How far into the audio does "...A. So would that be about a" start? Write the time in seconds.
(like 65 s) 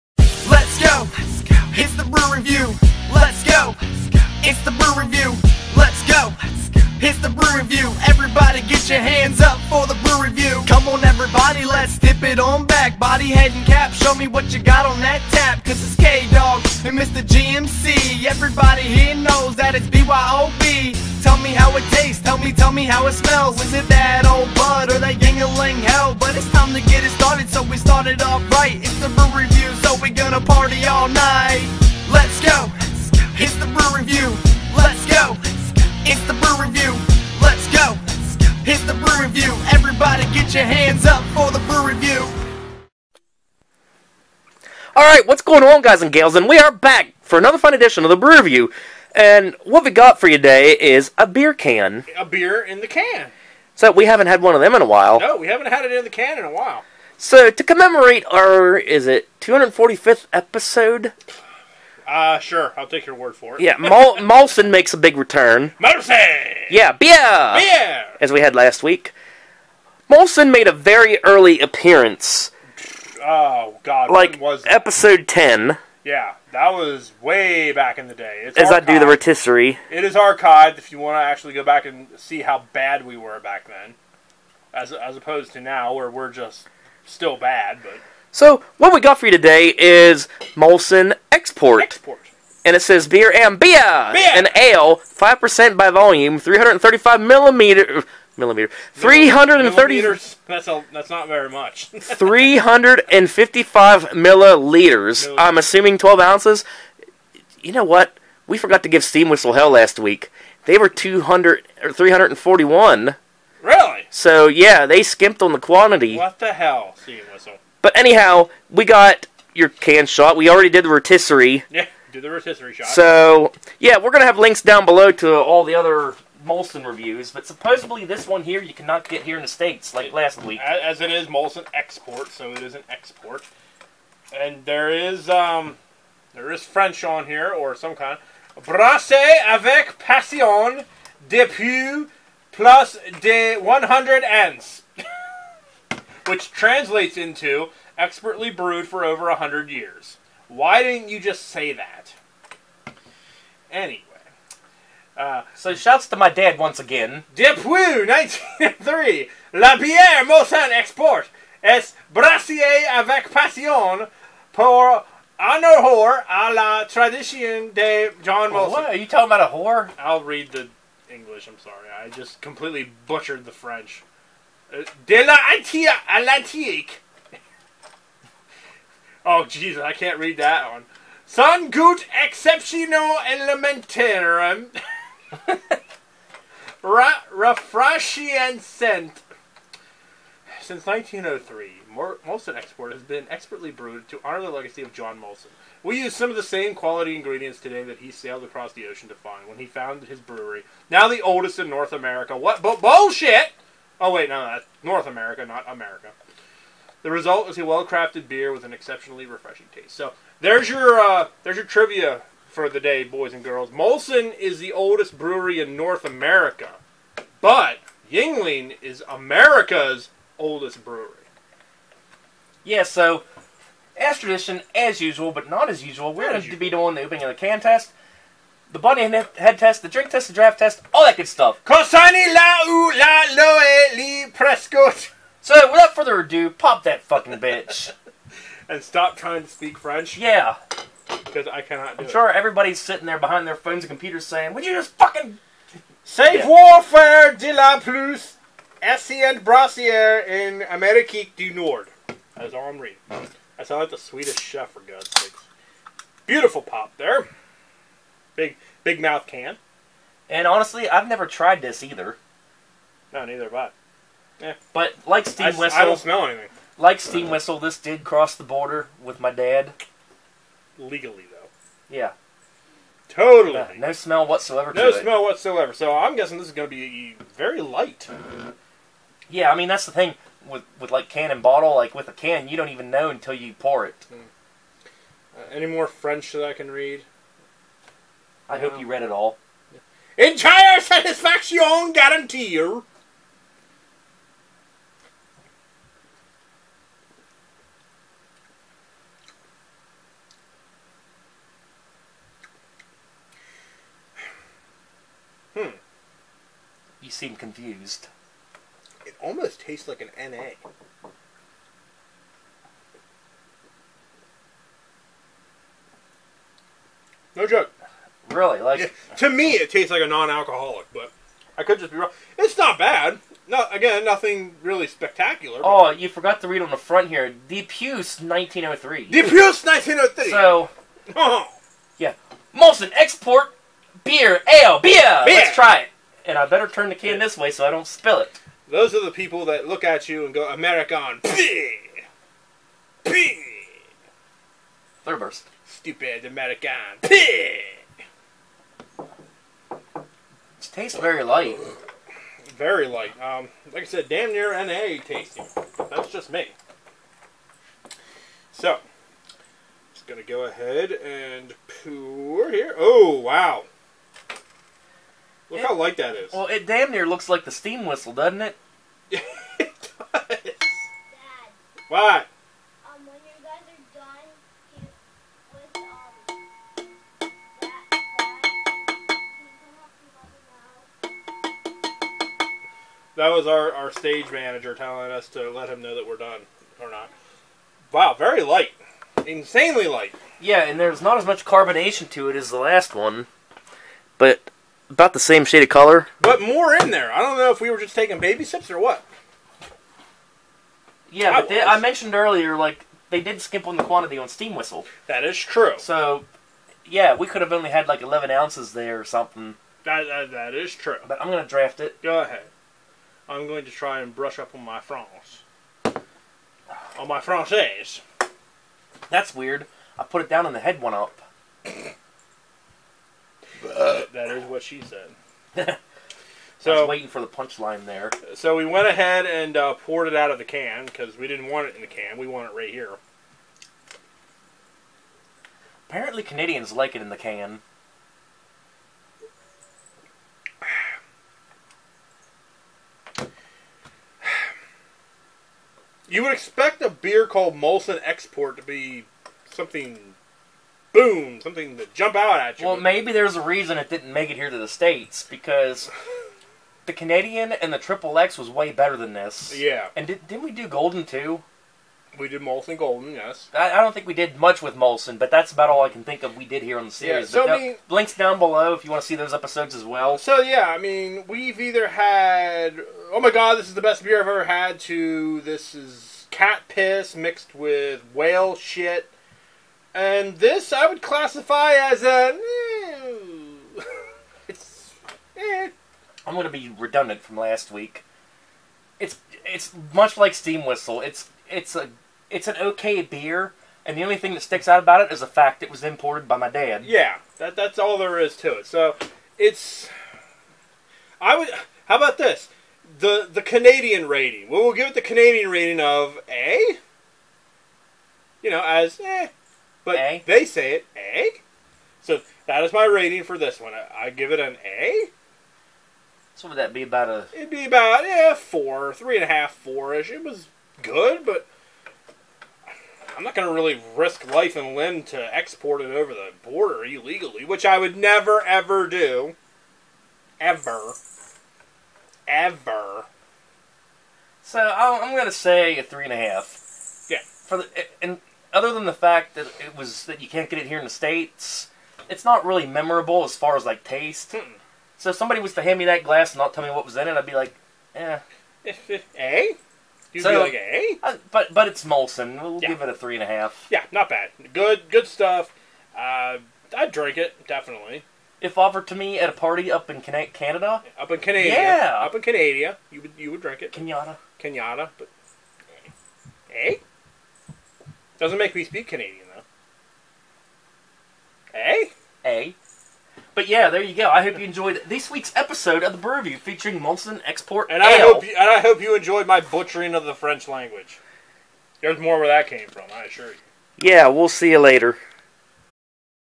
514 s.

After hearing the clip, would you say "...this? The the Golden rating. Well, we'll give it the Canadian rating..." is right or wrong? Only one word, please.
wrong.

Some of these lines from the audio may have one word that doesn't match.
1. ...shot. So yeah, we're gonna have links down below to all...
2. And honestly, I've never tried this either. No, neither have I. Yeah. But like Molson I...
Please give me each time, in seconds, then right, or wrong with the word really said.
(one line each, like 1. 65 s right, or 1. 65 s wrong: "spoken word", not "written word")
1. 122 s right
2. 260 s wrong: "Steam", not "Molson".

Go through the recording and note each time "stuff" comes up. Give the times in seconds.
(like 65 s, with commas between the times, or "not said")
231 s, 555 s.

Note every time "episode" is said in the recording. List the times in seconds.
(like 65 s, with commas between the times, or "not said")
60 s, 74 s, 469 s, 575 s.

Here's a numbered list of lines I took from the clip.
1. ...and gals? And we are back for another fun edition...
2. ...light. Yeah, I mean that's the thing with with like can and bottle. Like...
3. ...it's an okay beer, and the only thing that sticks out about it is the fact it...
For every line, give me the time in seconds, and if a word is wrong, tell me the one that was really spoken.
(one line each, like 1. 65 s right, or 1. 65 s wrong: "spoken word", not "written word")
1. 46 s right
2. 277 s right
3. 492 s right.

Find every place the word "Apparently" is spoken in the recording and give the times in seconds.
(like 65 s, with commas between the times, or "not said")
435 s.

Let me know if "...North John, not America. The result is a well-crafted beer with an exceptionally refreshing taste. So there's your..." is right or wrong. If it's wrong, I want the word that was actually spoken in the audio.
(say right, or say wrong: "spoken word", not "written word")
wrong: "America", not "John".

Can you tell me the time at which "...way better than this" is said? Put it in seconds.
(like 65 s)
458 s.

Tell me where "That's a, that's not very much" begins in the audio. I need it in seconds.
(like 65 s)
100 s.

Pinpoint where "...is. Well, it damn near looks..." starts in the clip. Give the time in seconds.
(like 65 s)
366 s.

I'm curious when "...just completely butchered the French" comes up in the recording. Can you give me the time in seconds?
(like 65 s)
172 s.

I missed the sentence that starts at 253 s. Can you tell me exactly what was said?
I sound like the Swedish chef, for God's sakes.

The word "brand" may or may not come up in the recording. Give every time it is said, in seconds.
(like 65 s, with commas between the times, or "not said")
not said.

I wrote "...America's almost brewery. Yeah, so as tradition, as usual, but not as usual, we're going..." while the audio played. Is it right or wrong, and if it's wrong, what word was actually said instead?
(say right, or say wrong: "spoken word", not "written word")
wrong: "oldest", not "almost".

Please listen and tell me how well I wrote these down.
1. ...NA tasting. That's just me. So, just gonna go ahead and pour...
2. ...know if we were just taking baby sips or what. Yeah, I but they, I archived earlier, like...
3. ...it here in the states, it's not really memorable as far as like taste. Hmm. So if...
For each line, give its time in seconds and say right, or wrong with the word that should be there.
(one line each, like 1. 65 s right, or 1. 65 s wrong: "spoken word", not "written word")
1. 354 s right
2. 397 s wrong: "mentioned", not "archived"
3. 540 s right.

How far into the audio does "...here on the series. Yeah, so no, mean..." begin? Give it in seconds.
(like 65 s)
466 s.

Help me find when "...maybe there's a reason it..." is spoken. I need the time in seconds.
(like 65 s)
452 s.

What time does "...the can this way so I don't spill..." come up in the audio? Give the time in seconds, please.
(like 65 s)
336 s.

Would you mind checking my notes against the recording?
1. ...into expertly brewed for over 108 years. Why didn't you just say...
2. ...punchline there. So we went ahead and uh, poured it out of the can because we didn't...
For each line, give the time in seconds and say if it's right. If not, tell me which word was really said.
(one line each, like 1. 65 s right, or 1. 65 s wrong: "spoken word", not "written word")
1. 147 s wrong: "100", not "108"
2. 427 s right.